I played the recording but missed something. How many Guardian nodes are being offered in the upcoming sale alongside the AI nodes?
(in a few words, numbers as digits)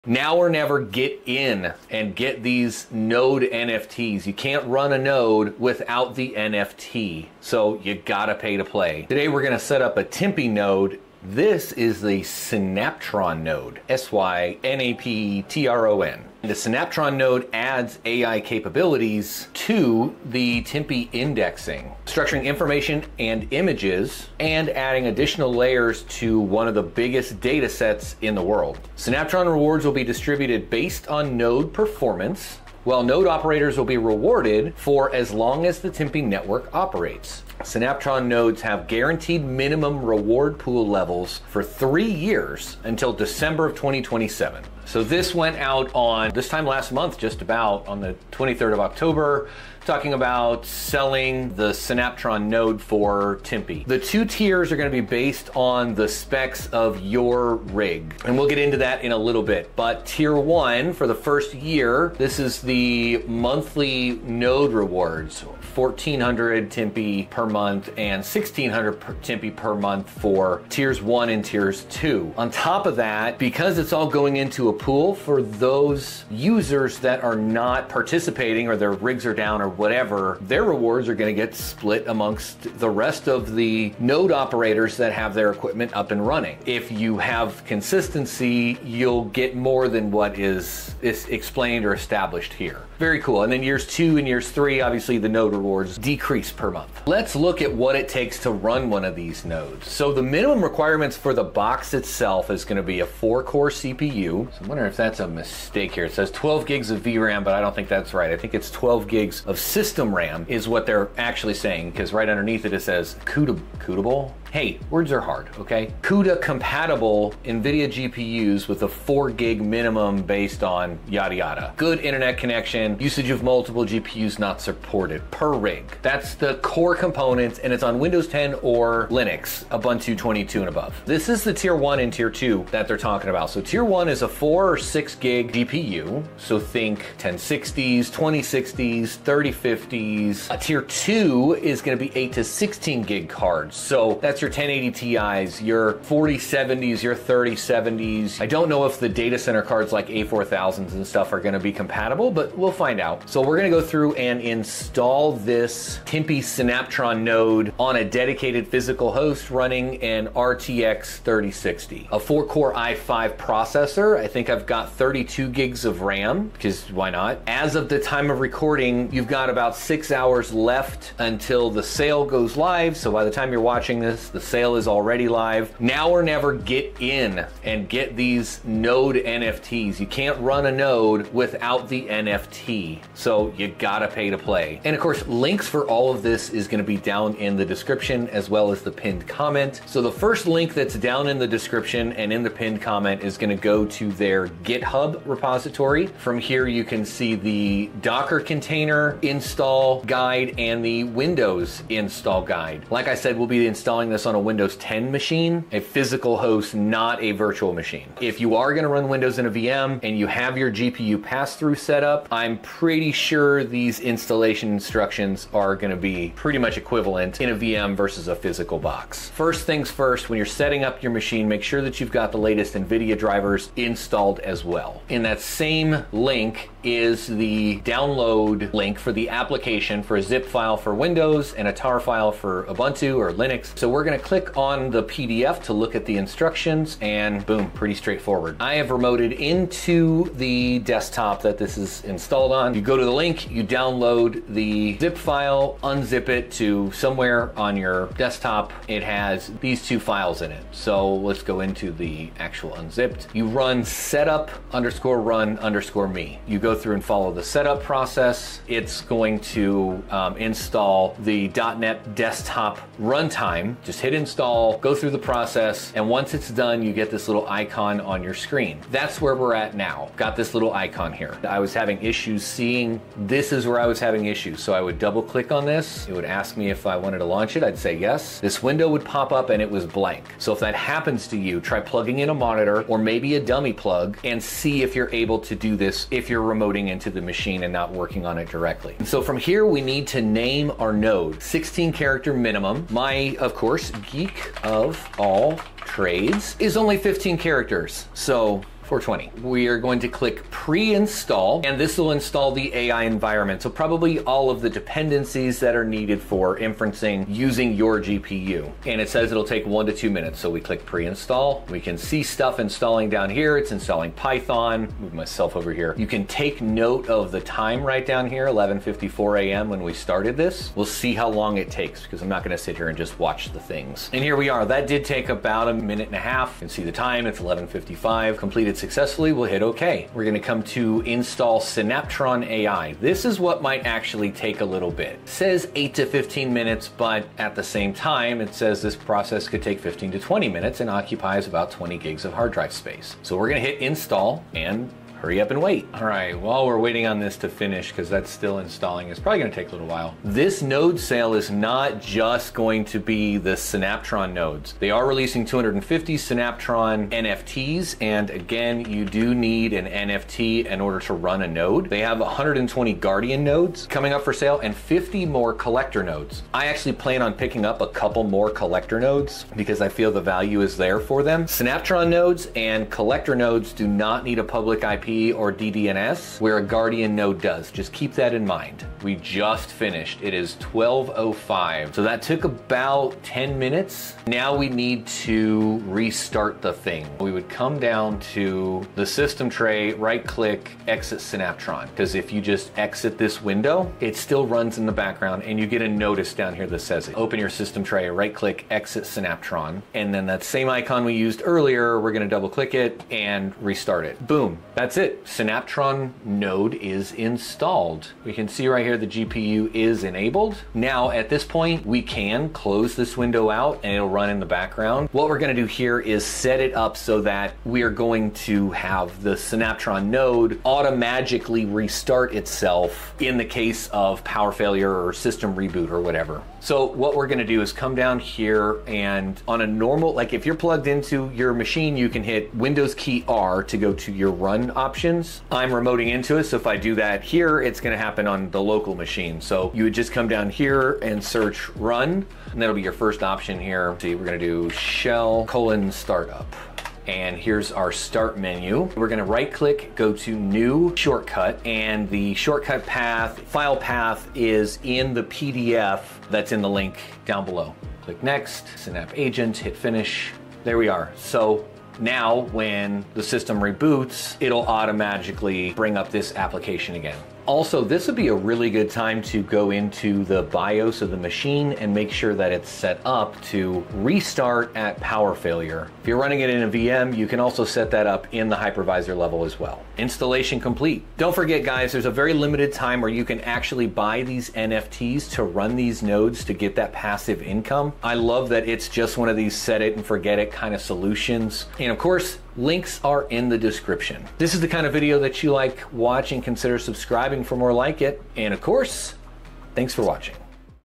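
120.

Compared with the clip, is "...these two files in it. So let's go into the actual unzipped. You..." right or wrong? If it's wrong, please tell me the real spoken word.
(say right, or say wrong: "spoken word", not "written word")
right.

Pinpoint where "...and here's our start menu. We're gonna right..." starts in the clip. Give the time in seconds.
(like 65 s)
447 s.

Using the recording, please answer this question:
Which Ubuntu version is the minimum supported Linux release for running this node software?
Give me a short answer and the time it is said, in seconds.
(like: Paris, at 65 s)
Ubuntu 22, at 129 s.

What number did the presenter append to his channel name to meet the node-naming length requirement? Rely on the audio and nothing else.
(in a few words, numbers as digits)
420.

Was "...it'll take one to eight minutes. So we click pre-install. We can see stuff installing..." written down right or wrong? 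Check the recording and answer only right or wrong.
wrong.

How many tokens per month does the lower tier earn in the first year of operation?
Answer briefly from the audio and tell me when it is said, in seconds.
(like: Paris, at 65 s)
1400, at 65 s.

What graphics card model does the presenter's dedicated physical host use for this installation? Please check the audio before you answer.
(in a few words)
RTX 3060.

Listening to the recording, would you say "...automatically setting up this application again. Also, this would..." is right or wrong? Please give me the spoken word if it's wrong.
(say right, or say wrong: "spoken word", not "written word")
wrong: "bring", not "setting".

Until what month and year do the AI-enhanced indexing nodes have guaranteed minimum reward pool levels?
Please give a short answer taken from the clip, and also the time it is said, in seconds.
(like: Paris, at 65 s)
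December 2027, at 43 s.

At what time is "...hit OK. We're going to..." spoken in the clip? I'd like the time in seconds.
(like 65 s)
329 s.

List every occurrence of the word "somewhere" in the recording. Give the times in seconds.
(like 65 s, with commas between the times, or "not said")
246 s.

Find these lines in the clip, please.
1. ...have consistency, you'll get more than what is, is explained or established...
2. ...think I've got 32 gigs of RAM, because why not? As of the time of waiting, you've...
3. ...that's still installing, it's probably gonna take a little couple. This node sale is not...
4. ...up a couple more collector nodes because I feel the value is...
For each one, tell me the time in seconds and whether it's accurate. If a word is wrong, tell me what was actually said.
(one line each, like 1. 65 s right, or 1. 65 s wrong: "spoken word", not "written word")
1. 87 s right
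2. 164 s wrong: "recording", not "waiting"
3. 348 s wrong: "while", not "couple"
4. 367 s right.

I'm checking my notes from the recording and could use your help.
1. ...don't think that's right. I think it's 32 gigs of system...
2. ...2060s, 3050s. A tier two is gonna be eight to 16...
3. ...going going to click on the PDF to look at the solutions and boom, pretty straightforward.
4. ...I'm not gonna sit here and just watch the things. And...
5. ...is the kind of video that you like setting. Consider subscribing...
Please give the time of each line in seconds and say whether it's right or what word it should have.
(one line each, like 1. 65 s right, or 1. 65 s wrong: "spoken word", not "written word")
1. 107 s wrong: "12", not "32"
2. 138 s right
3. 234 s wrong: "instructions", not "solutions"
4. 322 s right
5. 494 s wrong: "watching", not "setting".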